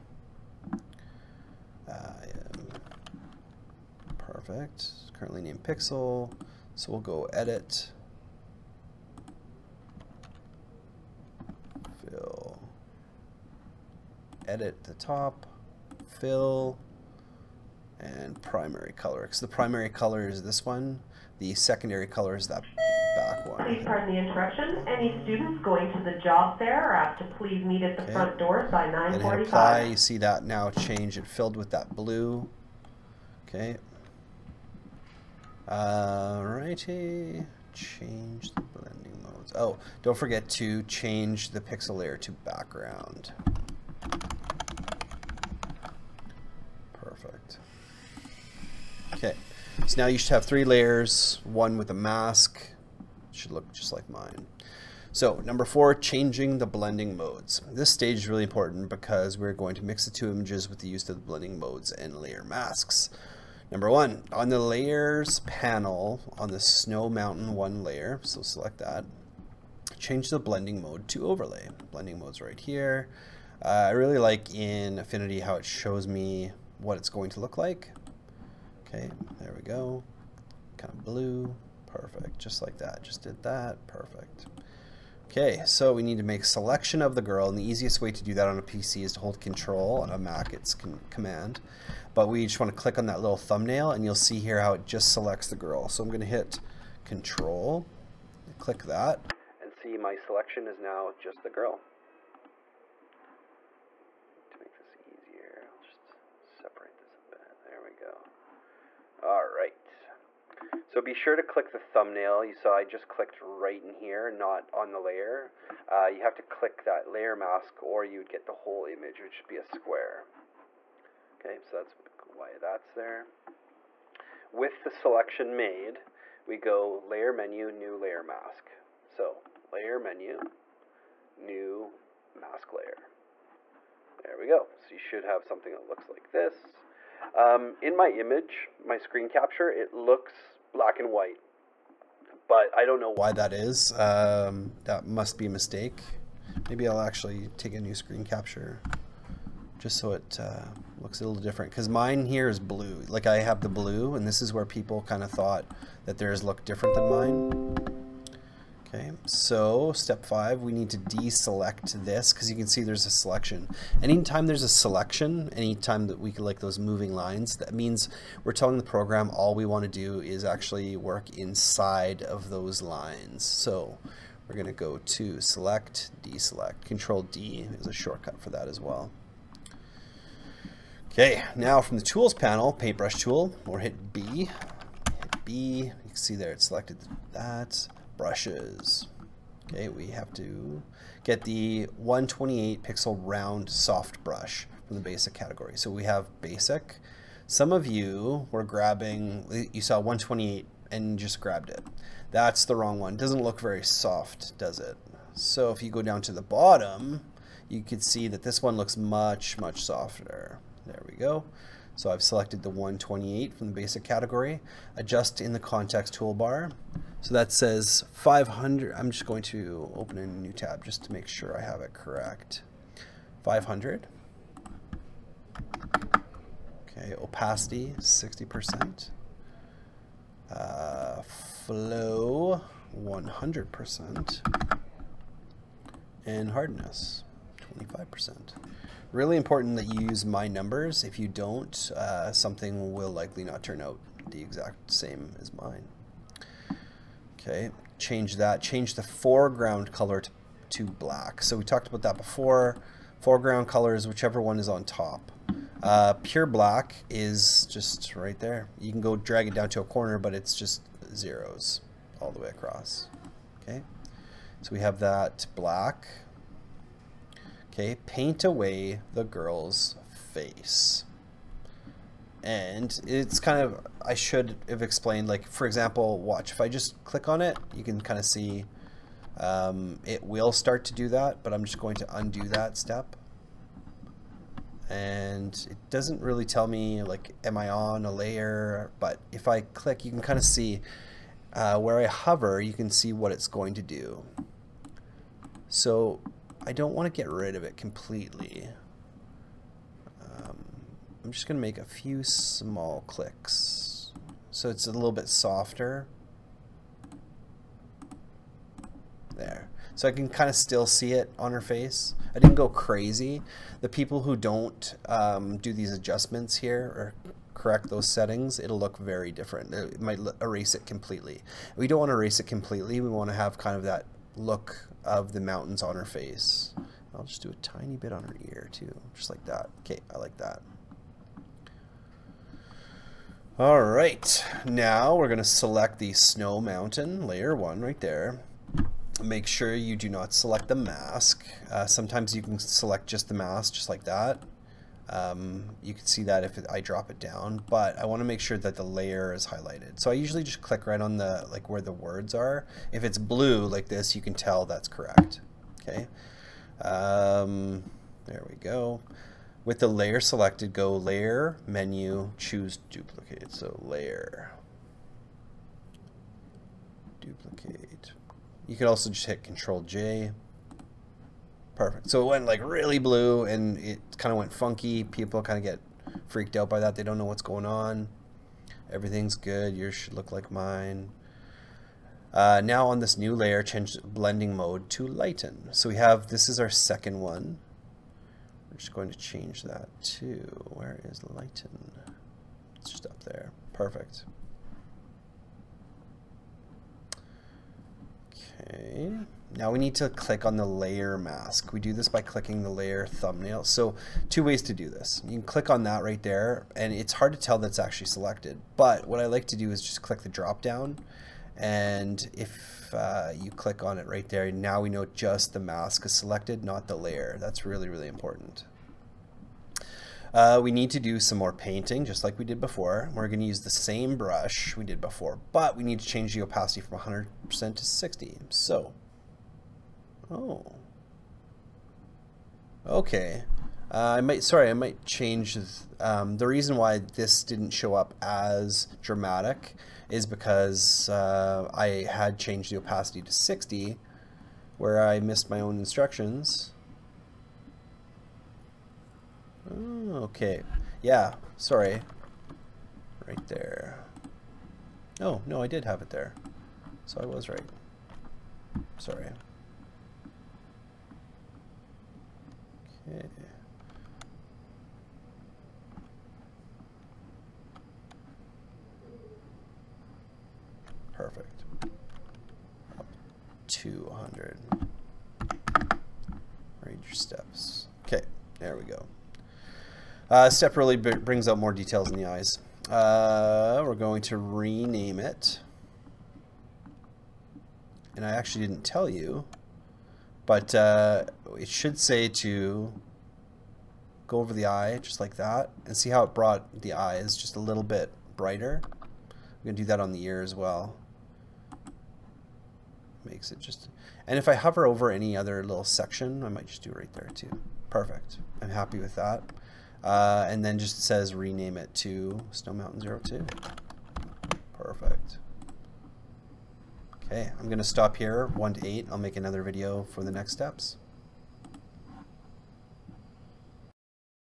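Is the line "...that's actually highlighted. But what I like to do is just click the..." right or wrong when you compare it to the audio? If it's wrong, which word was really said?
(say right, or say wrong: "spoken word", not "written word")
wrong: "selected", not "highlighted".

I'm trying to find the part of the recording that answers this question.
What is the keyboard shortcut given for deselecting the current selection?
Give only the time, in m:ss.
2:56.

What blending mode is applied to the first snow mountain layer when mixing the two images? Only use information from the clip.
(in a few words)
Overlay.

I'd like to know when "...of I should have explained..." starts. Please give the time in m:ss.
4:33.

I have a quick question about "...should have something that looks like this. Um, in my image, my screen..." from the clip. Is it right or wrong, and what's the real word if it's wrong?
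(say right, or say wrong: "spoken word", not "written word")
right.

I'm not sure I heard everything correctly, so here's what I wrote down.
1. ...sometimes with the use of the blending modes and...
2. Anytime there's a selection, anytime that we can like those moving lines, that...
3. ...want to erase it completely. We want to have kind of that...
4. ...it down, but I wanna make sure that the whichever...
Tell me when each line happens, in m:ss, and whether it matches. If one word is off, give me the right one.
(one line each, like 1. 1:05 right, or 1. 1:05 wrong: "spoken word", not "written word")
1. 1:00 wrong: "images", not "sometimes"
2. 2:44 right
3. 5:21 right
4. 5:47 wrong: "layer", not "whichever".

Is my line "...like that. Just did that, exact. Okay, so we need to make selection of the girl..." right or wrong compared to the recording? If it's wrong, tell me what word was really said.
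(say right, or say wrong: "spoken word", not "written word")
wrong: "perfect", not "exact".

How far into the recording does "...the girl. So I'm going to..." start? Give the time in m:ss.
1:35.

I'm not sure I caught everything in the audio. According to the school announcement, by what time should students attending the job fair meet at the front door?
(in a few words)
9:45.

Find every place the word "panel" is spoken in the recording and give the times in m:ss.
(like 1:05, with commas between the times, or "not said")
1:05, 3:02.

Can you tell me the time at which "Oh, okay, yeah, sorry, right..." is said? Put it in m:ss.
7:29.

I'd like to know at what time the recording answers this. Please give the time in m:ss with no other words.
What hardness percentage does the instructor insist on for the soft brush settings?
3:57.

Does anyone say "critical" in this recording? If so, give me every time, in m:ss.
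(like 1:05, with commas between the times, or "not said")
not said.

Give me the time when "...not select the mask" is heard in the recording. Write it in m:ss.
5:40.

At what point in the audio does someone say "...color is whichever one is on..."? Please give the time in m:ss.
4:13.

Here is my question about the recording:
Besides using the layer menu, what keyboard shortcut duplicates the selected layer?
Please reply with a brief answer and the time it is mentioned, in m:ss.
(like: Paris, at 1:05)
Control J, at 6:09.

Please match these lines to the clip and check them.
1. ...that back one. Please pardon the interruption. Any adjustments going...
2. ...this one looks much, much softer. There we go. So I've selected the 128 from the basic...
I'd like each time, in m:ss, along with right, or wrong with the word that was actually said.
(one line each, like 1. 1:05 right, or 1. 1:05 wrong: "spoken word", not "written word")
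1. 0:22 wrong: "students", not "adjustments"
2. 3:28 right.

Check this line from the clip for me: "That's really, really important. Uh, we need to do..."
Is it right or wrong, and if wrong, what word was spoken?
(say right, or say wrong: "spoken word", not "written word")
right.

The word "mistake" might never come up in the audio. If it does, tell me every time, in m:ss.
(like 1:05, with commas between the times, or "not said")
2:25.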